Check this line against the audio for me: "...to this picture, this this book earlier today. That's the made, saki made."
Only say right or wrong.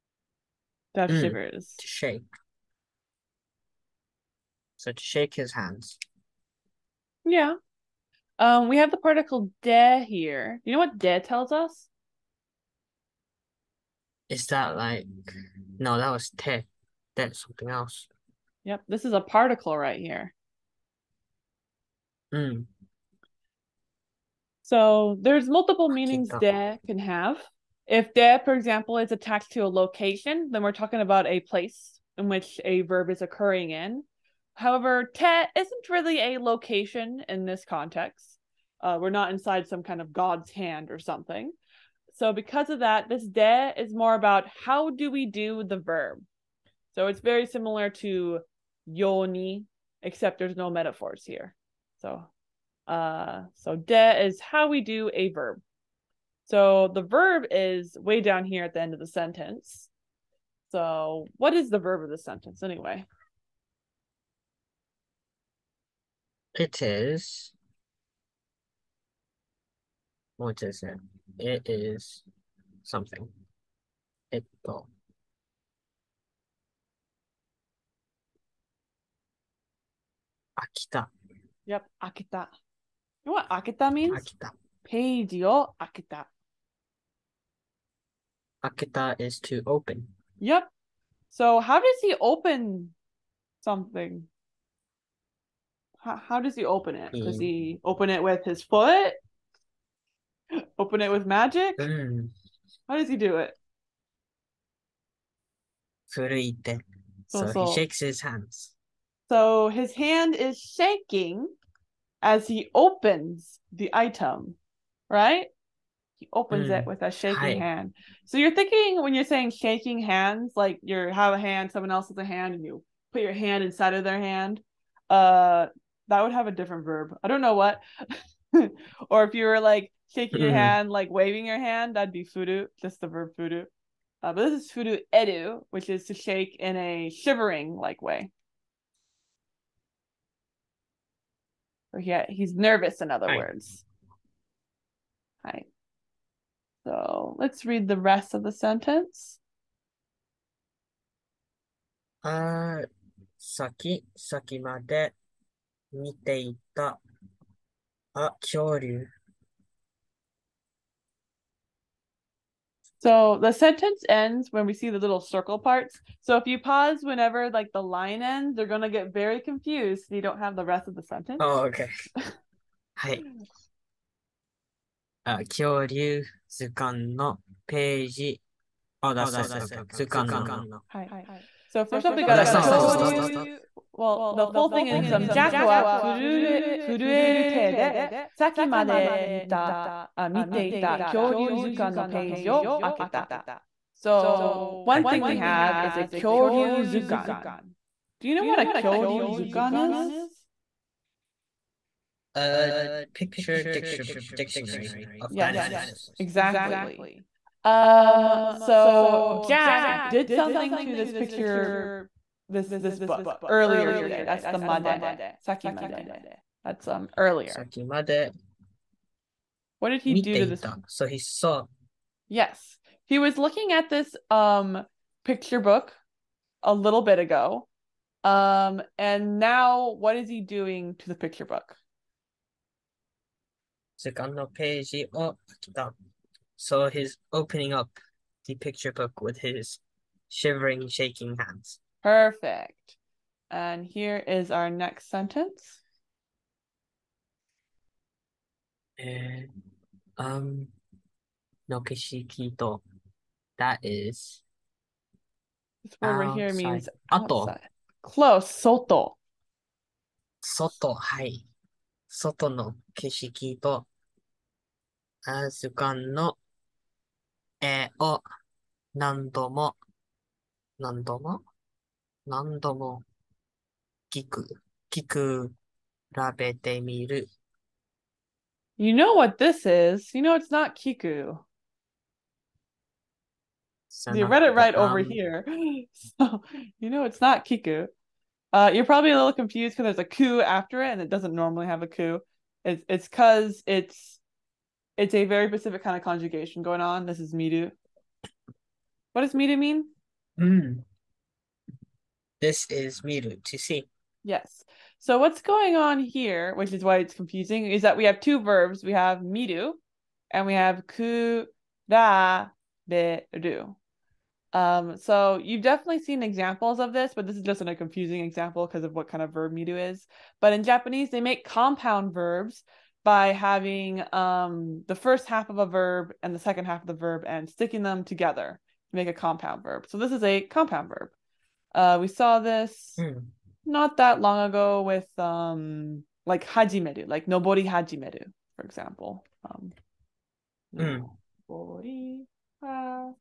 right.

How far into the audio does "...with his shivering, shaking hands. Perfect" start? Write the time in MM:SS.
03:59.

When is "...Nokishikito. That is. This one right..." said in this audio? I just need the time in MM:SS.
04:11.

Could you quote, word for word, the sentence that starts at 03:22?
A picture dictionary of yes, dinosaurs.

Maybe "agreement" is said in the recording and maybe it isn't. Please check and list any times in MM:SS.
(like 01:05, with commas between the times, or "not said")
not said.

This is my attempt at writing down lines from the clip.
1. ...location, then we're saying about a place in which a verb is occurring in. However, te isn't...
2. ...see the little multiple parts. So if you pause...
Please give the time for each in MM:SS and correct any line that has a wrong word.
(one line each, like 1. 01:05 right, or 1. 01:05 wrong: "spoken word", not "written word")
1. 00:29 wrong: "talking", not "saying"
2. 02:44 wrong: "circle", not "multiple".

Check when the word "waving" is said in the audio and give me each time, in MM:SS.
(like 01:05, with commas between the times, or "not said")
02:11.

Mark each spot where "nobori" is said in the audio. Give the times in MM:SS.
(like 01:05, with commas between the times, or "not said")
05:37, 05:41.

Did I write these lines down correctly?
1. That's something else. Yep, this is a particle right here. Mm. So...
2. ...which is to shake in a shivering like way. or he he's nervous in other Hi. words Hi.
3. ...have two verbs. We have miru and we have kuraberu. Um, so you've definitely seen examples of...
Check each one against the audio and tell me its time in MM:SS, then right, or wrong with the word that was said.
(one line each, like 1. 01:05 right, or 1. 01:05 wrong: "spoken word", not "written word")
1. 00:17 right
2. 02:15 right
3. 05:08 right.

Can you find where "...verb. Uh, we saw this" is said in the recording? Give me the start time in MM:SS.
05:30.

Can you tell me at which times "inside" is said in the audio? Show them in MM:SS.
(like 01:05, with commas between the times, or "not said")
00:39, 02:03.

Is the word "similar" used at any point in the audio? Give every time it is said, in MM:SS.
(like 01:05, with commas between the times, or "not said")
00:47.